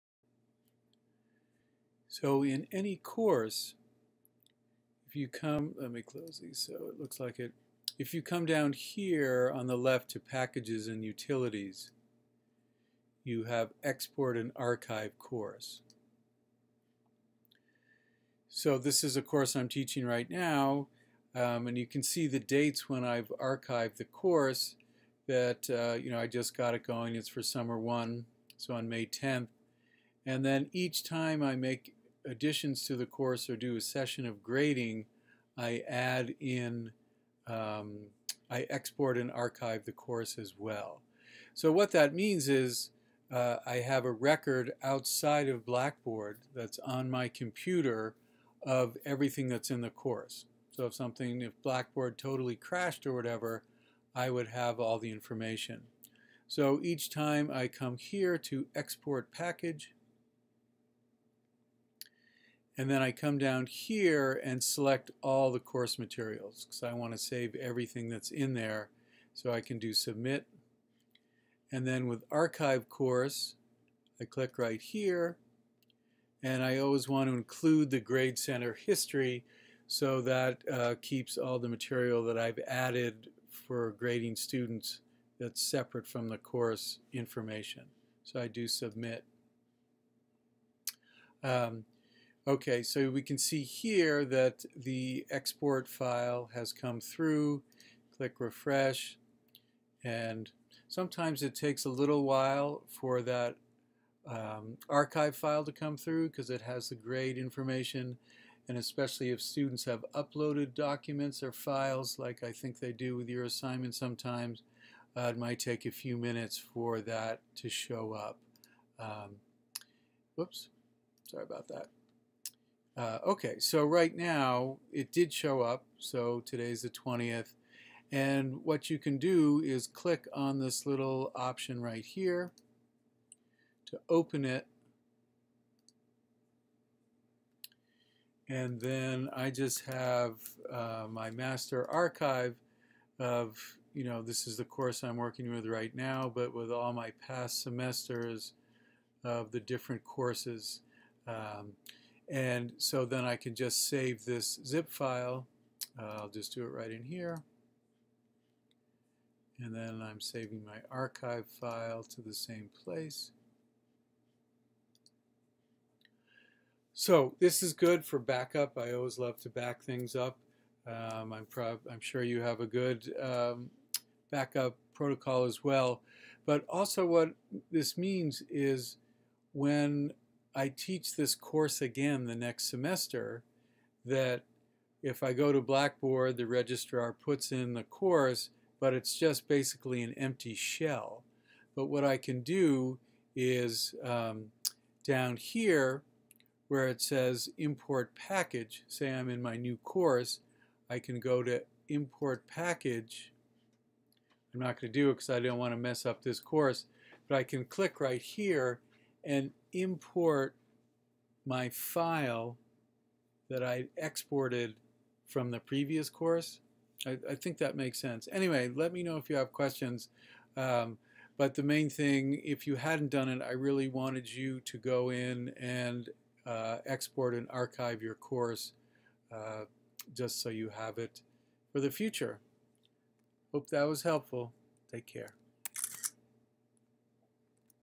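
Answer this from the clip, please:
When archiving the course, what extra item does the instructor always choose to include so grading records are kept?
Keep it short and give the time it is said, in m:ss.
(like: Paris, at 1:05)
Grade Center history, at 1:17.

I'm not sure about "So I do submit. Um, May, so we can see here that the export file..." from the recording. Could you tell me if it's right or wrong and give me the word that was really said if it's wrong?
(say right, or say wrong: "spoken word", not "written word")
wrong: "Okay", not "May".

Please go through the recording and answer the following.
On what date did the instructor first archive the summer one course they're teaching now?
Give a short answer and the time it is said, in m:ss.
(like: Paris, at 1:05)
May 10th, at 0:28.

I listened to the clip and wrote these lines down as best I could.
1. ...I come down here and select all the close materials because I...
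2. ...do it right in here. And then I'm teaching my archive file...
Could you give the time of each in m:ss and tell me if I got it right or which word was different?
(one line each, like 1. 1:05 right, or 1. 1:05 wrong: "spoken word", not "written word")
1. 1:03 wrong: "course", not "close"
2. 2:36 wrong: "saving", not "teaching".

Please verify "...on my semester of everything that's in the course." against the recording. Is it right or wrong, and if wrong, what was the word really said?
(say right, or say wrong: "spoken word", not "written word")
wrong: "computer", not "semester".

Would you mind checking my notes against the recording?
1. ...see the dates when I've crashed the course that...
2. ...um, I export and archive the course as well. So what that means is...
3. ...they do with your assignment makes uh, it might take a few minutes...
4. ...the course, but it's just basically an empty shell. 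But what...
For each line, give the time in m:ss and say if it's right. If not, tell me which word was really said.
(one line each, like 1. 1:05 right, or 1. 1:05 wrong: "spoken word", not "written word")
1. 0:22 wrong: "archived", not "crashed"
2. 0:37 right
3. 1:52 wrong: "sometimes", not "makes"
4. 3:07 right.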